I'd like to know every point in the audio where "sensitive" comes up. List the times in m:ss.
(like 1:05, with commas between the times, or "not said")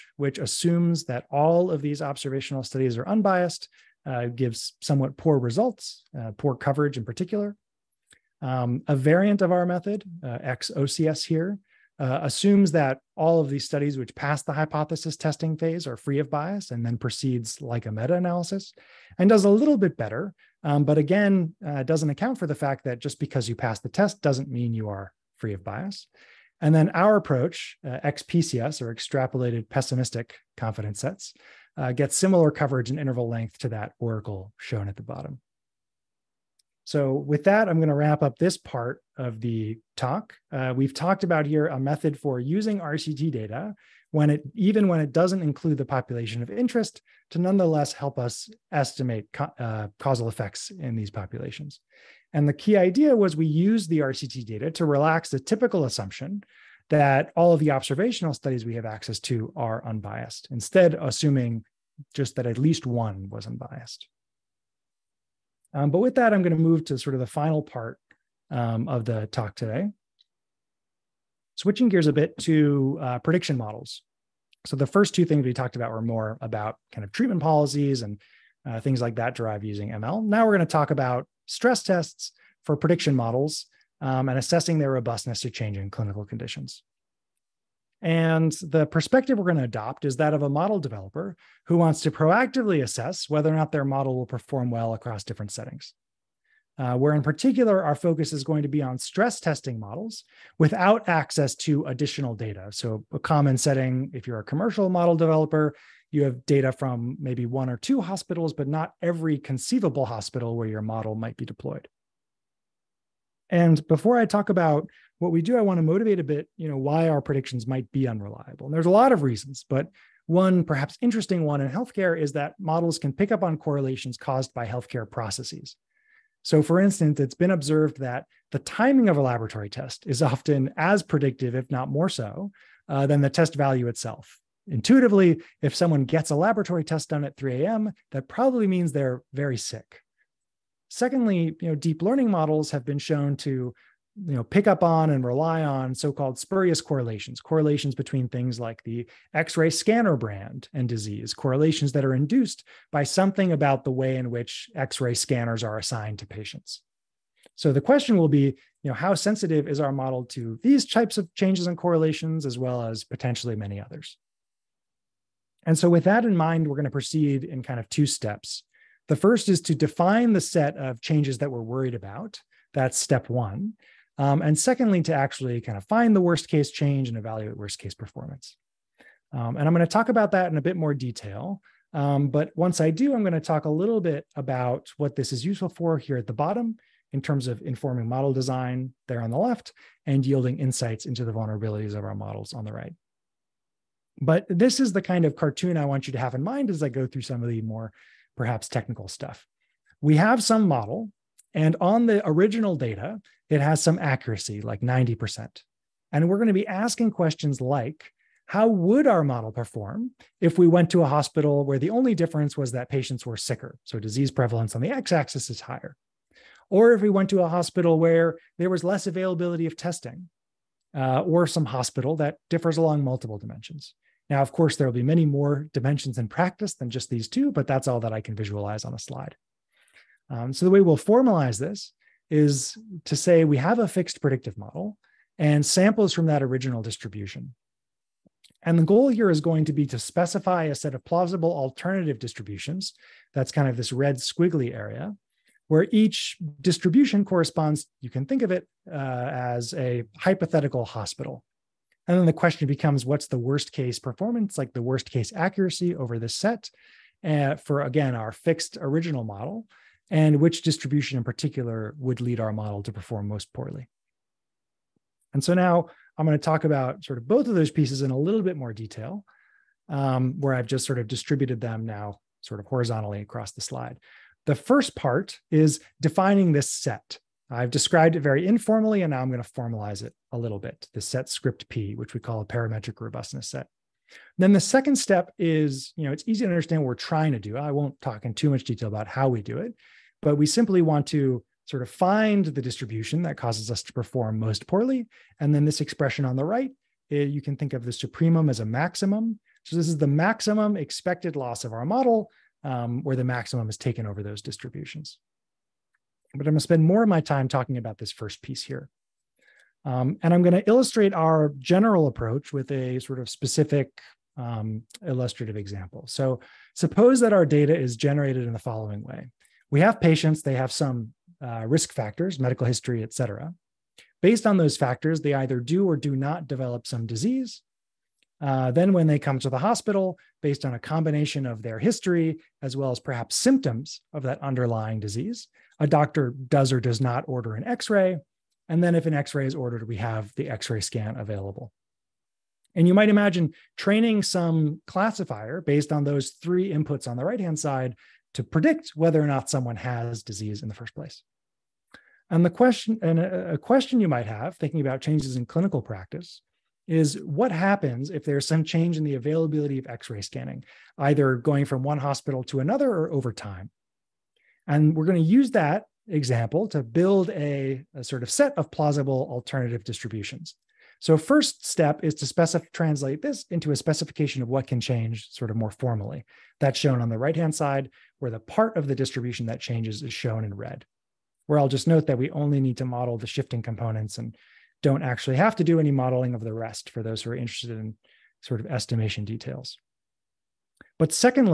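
2:39.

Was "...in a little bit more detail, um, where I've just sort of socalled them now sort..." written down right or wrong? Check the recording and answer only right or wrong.
wrong.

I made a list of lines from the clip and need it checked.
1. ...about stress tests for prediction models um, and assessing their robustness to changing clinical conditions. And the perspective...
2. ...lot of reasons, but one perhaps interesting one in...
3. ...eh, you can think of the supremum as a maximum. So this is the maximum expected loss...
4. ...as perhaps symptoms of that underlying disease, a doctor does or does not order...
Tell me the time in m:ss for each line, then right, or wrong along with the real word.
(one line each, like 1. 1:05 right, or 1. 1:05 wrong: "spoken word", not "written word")
1. 1:20 right
2. 1:58 right
3. 4:57 right
4. 5:32 right.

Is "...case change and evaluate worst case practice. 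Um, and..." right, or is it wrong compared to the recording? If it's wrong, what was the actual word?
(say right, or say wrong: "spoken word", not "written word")
wrong: "performance", not "practice".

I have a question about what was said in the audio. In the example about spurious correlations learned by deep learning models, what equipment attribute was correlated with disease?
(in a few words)
x-ray scanner brand.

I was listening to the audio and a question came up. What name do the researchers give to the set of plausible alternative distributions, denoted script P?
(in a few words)
parametric robustness set.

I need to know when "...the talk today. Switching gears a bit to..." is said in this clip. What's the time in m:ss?
1:09.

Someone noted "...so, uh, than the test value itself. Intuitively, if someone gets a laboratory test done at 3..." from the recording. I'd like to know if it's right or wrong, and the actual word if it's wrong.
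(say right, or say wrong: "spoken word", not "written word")
right.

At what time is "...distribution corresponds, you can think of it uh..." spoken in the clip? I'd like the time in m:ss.
4:06.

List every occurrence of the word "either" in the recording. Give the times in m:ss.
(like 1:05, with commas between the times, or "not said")
5:25, 6:00.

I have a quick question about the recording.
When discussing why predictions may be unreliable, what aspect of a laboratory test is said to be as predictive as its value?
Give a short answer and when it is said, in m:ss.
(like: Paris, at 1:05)
the timing, at 2:08.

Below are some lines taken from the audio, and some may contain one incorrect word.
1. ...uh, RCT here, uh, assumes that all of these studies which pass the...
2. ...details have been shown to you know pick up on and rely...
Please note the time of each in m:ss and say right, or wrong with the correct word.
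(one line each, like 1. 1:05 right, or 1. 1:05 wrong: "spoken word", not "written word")
1. 0:10 wrong: "XOCS", not "RCT"
2. 2:22 wrong: "models", not "details".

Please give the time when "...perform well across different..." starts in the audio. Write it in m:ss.
1:34.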